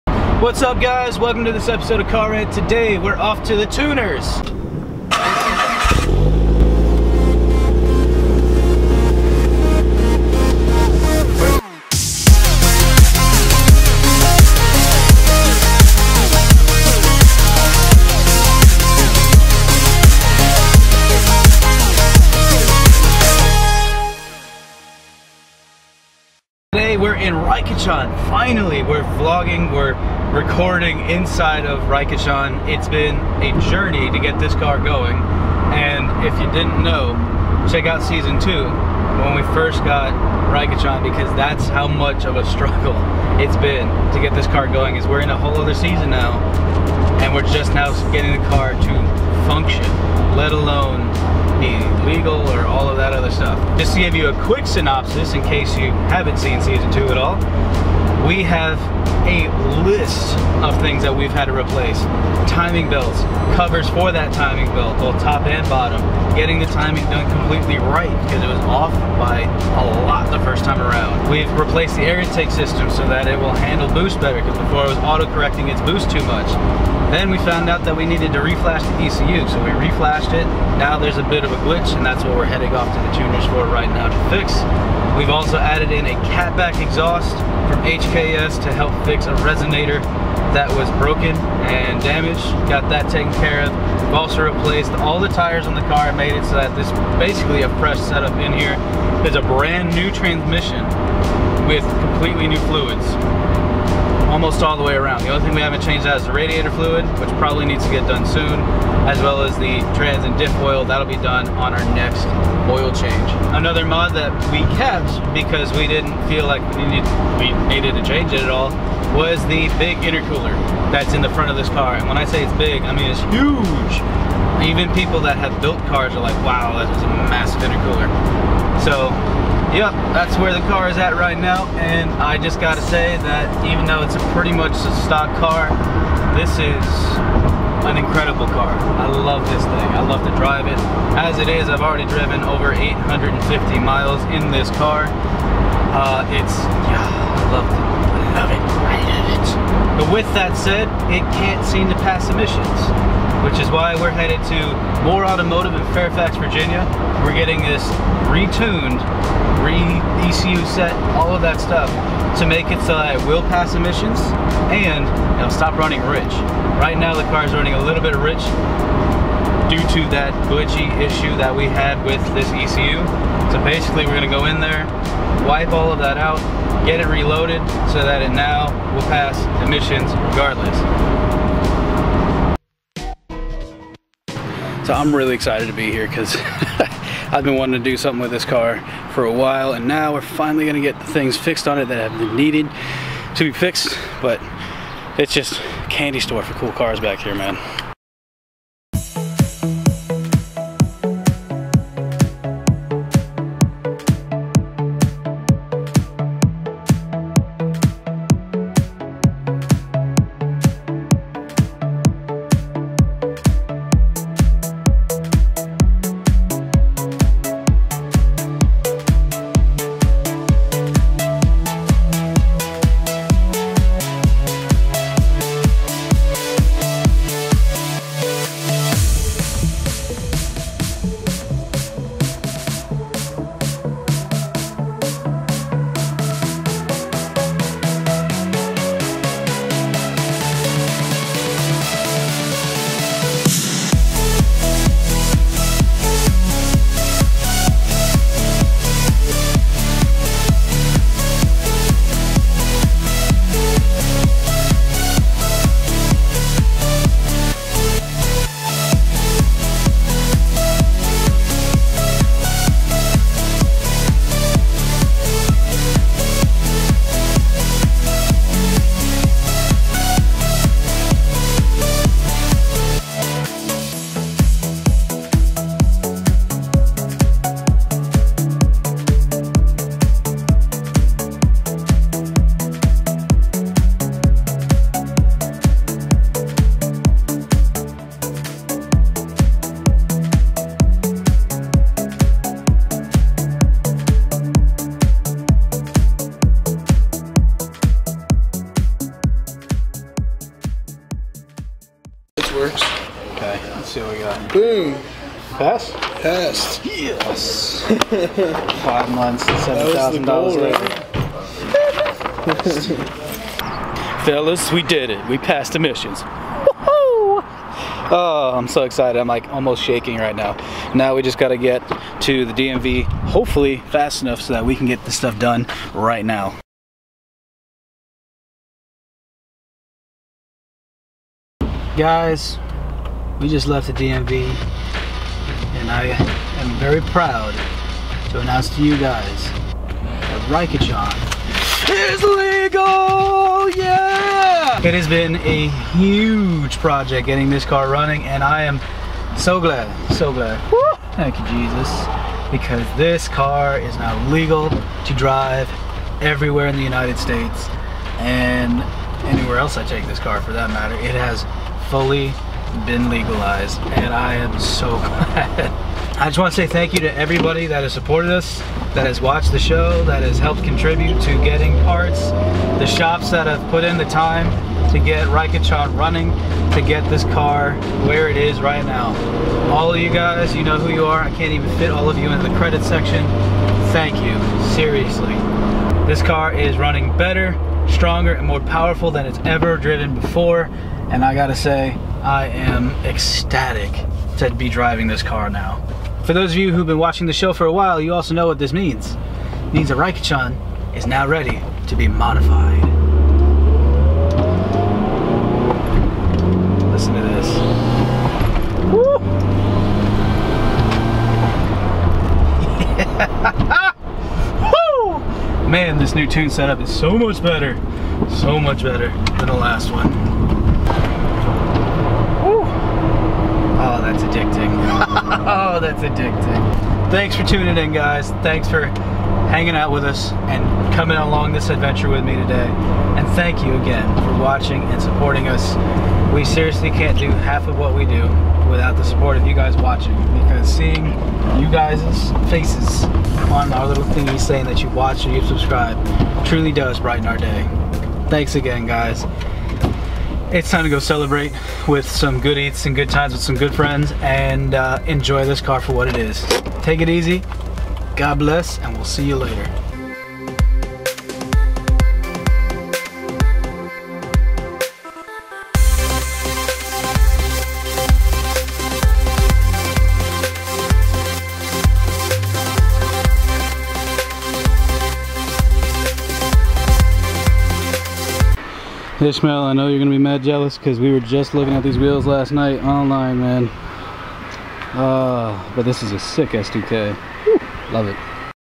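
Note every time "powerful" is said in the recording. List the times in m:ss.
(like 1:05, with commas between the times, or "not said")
6:28.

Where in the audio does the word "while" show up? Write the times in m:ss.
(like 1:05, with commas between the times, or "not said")
3:09, 6:37.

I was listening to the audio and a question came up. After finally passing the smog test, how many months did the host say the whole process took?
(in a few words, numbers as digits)
5.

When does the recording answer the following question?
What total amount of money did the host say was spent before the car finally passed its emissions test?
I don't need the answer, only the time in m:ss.
5:09.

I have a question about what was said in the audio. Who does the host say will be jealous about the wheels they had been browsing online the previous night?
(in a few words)
Ishmael.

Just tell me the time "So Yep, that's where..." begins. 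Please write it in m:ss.
2:08.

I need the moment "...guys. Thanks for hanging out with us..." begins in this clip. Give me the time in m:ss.
7:07.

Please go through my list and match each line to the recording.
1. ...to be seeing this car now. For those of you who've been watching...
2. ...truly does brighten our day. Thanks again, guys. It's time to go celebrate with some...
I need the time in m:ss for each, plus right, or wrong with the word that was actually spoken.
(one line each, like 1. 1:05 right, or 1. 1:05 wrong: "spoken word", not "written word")
1. 6:34 wrong: "driving", not "seeing"
2. 7:26 right.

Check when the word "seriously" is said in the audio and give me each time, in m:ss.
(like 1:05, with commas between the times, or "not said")
6:24, 7:16.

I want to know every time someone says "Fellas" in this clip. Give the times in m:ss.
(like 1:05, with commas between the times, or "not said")
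5:14.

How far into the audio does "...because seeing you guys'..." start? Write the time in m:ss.
7:20.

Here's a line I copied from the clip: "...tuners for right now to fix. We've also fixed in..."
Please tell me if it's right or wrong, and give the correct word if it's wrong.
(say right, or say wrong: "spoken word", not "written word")
wrong: "added", not "fixed".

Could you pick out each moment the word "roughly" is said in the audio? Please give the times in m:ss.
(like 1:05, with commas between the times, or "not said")
not said.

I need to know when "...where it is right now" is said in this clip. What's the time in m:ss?
6:18.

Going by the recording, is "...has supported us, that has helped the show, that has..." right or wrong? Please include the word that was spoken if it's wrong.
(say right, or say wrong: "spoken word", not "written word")
wrong: "watched", not "helped".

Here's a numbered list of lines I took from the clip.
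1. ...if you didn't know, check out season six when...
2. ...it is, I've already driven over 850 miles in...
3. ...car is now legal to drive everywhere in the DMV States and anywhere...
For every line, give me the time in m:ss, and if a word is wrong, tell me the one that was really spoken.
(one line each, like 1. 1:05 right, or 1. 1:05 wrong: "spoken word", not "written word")
1. 0:36 wrong: "two", not "six"
2. 2:21 right
3. 5:53 wrong: "United", not "DMV".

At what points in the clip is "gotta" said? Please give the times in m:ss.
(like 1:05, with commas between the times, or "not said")
2:12, 6:31.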